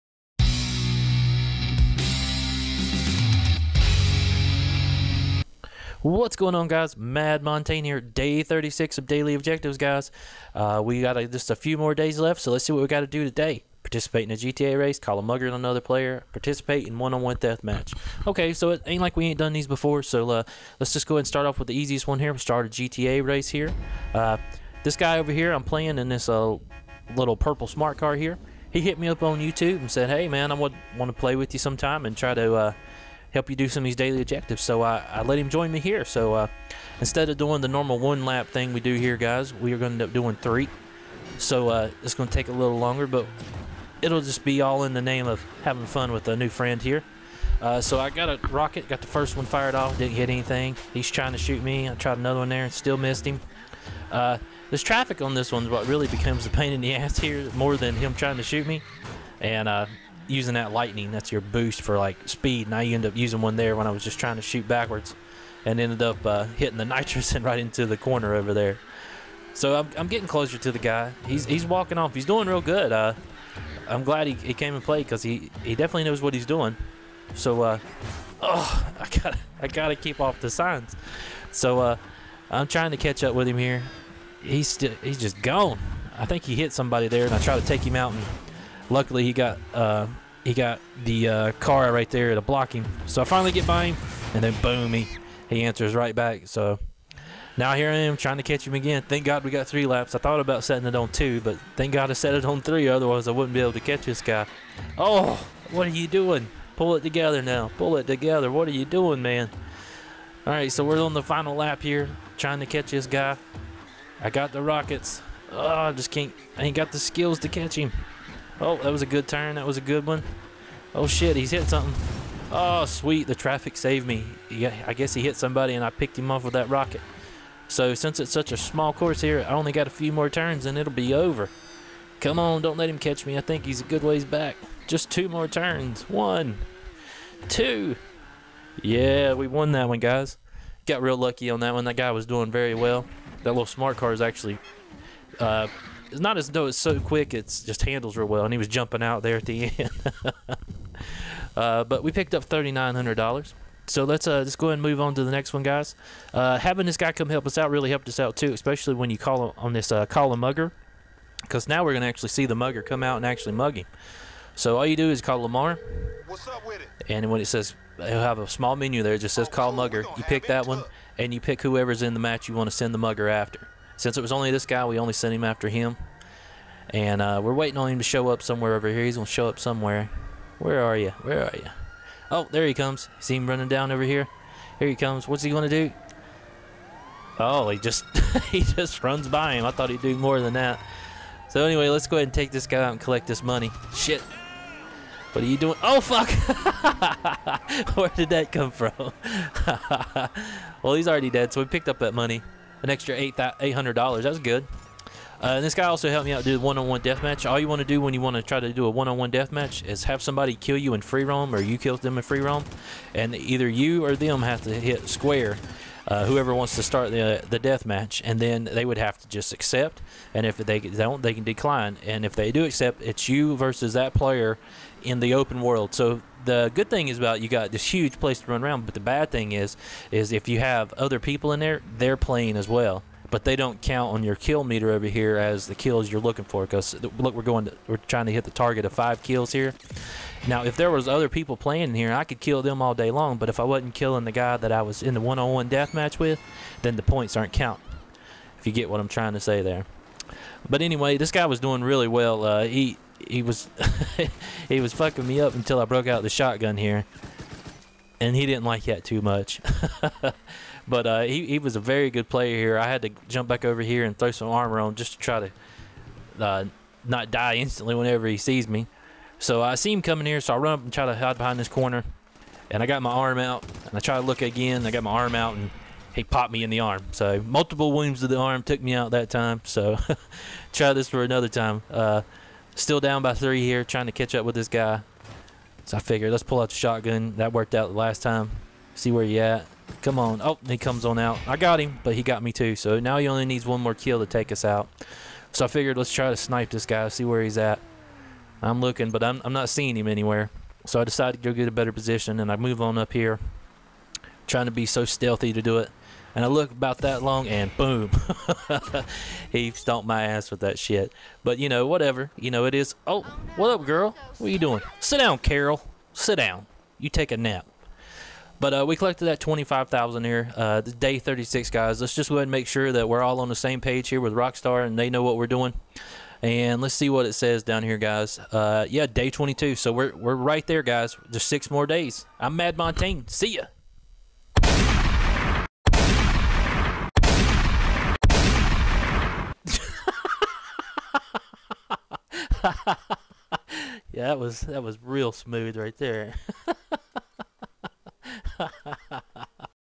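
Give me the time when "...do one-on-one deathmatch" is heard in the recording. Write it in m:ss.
3:26.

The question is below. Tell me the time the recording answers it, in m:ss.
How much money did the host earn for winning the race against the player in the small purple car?
2:32.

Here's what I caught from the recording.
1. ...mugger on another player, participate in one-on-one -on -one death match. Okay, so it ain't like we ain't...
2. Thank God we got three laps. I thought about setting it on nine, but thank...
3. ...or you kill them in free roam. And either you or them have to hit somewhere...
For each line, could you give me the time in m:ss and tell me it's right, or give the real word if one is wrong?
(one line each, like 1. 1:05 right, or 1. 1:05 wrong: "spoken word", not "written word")
1. 0:15 right
2. 1:39 wrong: "two", not "nine"
3. 3:31 wrong: "square", not "somewhere".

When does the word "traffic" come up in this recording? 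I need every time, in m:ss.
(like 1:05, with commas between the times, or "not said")
0:54, 2:03.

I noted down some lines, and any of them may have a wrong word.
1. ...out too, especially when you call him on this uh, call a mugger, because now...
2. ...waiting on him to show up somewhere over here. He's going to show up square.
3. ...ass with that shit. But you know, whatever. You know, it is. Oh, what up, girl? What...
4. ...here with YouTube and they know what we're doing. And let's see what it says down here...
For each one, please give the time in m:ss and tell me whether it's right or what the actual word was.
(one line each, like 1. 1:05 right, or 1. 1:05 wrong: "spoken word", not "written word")
1. 2:38 right
2. 2:57 wrong: "somewhere", not "square"
3. 5:10 right
4. 5:24 wrong: "Rockstar", not "YouTube".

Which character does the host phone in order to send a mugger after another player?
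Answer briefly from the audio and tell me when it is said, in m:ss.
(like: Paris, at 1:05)
Lamar, at 2:45.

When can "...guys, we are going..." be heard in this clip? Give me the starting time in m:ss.
0:39.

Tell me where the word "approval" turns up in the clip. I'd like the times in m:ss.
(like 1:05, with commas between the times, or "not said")
not said.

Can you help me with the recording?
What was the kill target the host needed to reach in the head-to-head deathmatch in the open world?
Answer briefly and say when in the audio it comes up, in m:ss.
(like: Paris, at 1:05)
5, at 3:58.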